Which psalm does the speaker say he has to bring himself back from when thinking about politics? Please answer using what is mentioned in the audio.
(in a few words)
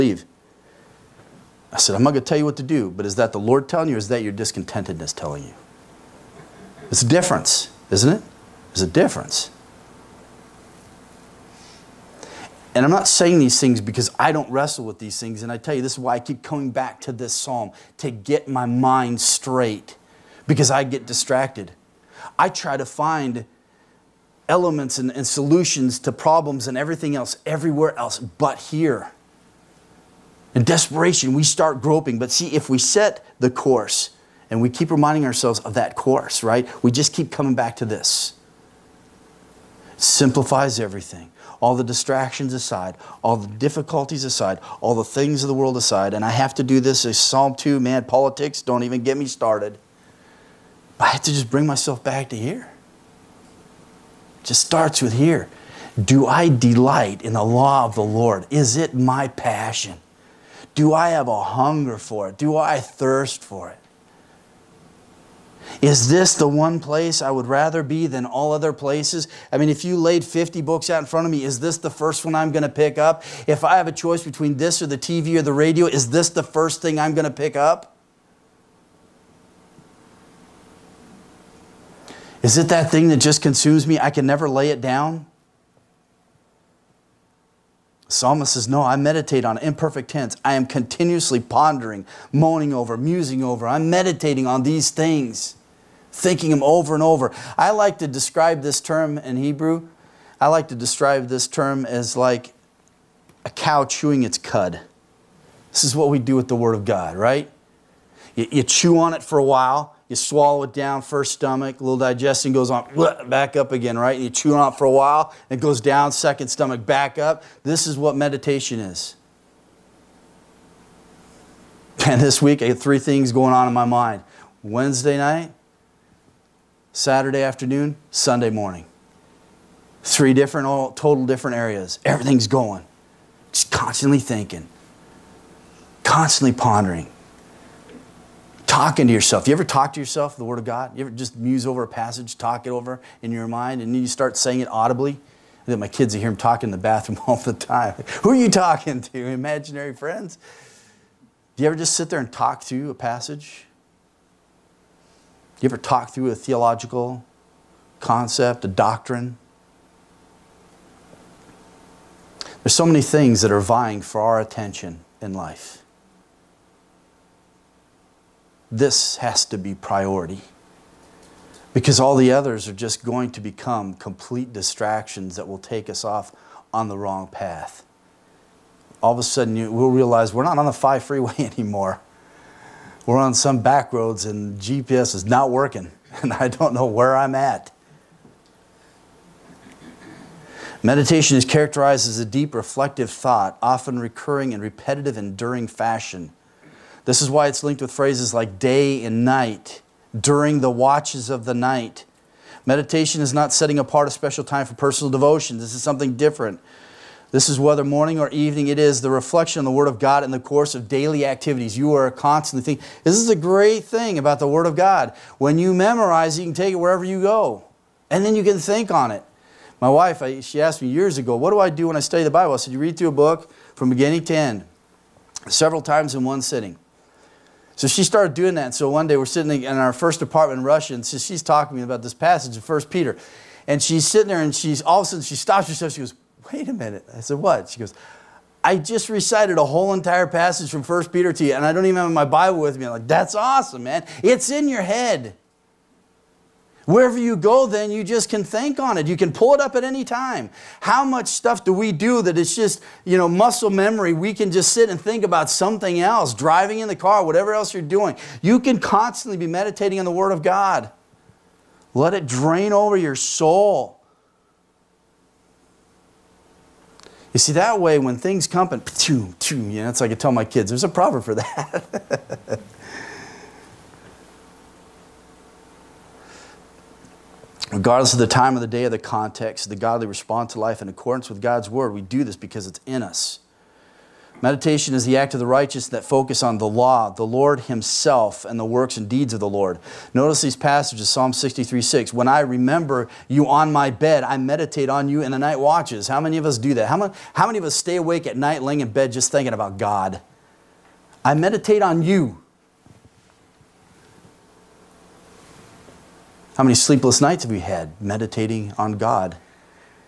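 Psalm 2.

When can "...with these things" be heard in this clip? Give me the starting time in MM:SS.
00:14.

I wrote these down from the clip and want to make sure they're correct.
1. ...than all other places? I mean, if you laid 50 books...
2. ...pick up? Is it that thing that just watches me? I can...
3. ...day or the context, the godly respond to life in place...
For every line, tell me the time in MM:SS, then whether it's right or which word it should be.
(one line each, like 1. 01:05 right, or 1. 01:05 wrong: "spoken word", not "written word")
1. 01:08 right
2. 01:17 wrong: "consumes", not "watches"
3. 04:38 wrong: "accordance", not "place".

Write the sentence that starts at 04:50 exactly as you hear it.
Notice these passages, Psalm 63, 6.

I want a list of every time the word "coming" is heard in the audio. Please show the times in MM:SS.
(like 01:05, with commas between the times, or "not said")
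00:16, 00:37.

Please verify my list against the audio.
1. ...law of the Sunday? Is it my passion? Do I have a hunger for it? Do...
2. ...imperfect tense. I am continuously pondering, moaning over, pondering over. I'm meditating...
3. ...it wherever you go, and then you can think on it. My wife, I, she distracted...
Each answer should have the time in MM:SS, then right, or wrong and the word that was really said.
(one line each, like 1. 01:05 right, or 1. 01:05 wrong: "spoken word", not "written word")
1. 00:57 wrong: "Lord", not "Sunday"
2. 01:29 wrong: "musing", not "pondering"
3. 03:36 wrong: "asked", not "distracted".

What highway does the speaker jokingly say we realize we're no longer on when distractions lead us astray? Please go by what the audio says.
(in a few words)
The 5 freeway.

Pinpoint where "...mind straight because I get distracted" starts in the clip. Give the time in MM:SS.
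00:18.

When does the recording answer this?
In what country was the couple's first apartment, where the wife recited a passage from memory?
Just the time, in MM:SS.
03:50.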